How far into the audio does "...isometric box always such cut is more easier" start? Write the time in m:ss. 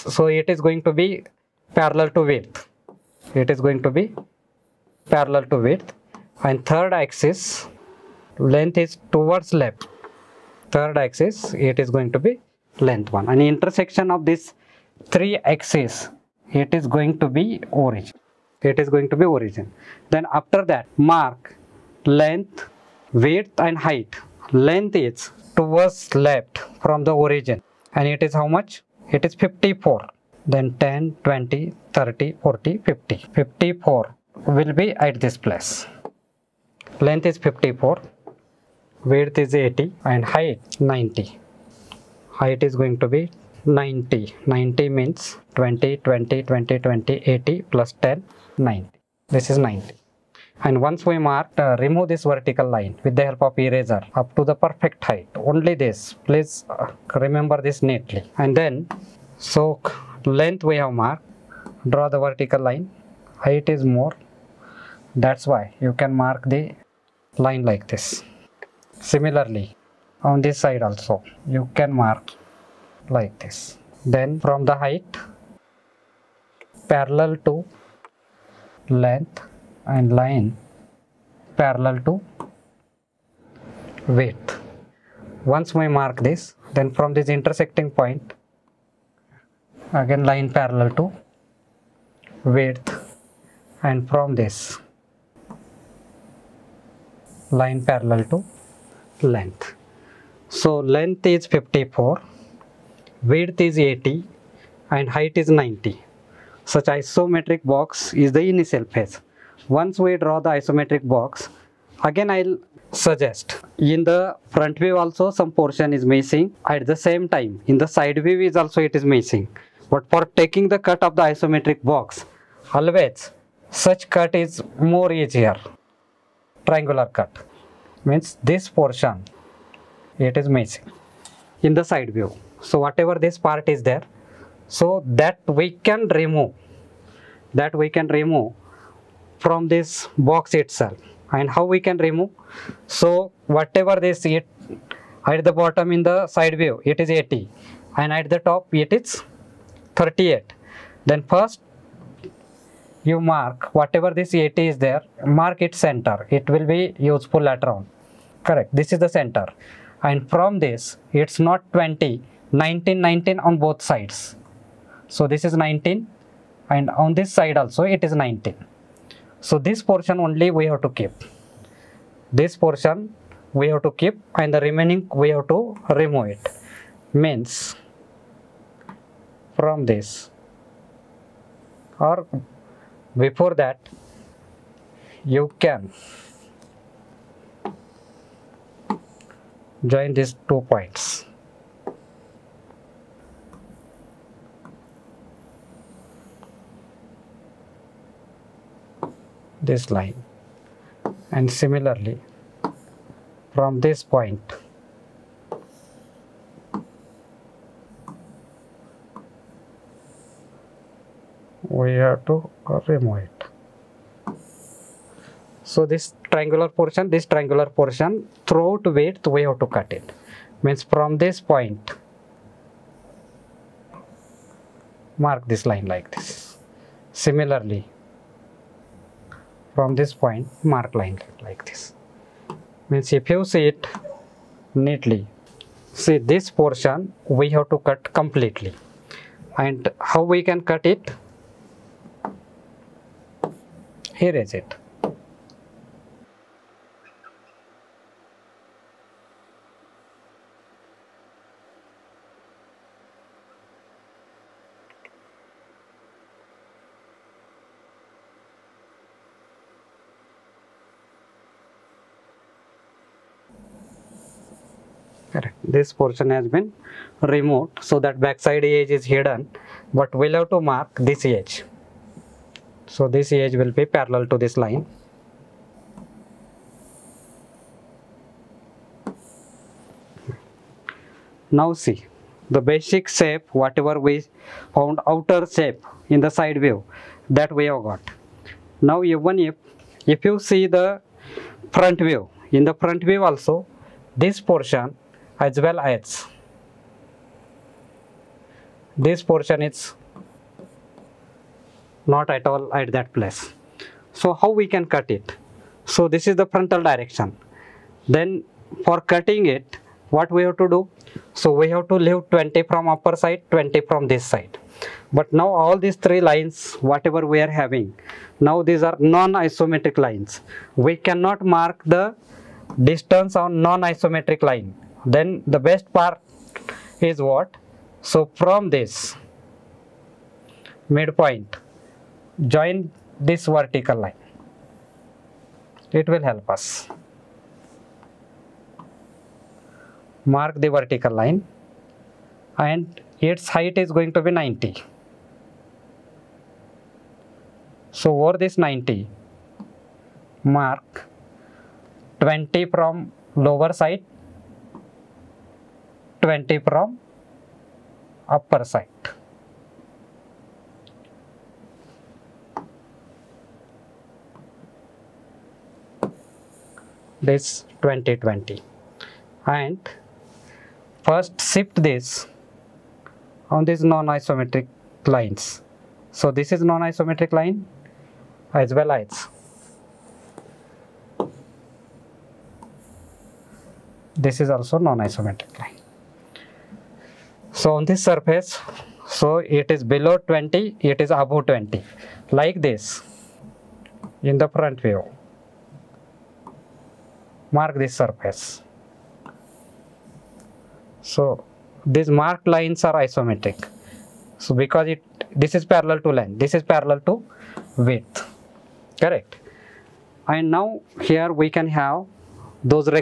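2:01.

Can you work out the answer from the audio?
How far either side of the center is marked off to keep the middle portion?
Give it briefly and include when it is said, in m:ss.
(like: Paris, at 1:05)
19, at 2:42.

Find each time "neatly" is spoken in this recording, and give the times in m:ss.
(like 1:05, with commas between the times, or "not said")
0:57, 3:54.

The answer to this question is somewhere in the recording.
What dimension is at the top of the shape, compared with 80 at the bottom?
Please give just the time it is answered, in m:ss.
2:29.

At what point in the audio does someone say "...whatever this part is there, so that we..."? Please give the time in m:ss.
2:12.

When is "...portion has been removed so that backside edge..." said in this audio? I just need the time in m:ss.
4:25.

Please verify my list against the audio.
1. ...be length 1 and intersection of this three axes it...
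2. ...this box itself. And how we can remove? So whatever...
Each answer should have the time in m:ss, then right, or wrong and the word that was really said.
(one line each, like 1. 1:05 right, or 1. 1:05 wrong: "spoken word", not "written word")
1. 0:12 right
2. 2:19 right.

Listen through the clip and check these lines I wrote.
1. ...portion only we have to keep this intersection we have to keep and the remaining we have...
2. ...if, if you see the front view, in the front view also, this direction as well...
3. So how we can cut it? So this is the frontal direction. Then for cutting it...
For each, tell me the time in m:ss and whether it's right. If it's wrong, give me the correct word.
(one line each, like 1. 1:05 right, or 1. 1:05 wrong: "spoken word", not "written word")
1. 2:49 wrong: "portion", not "intersection"
2. 4:49 wrong: "portion", not "direction"
3. 5:04 right.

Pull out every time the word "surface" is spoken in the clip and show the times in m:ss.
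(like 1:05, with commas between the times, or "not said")
6:28, 6:37.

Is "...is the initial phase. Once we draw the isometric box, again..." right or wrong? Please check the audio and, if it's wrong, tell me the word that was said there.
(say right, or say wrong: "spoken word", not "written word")
right.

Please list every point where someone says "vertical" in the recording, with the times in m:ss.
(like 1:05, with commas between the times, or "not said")
0:52, 1:02, 5:33, 5:40.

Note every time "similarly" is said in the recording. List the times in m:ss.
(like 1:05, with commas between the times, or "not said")
1:09, 3:21, 3:47.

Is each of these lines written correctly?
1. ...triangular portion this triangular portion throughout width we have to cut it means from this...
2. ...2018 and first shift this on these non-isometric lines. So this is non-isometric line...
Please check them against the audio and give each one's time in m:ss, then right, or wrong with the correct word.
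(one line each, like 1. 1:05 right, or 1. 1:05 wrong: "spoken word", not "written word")
1. 3:36 right
2. 6:07 wrong: "2020", not "2018".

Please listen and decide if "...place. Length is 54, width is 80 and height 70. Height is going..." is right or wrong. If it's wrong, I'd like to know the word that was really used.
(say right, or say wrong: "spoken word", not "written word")
wrong: "90", not "70".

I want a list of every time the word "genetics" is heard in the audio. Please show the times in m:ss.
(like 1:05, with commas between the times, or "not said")
not said.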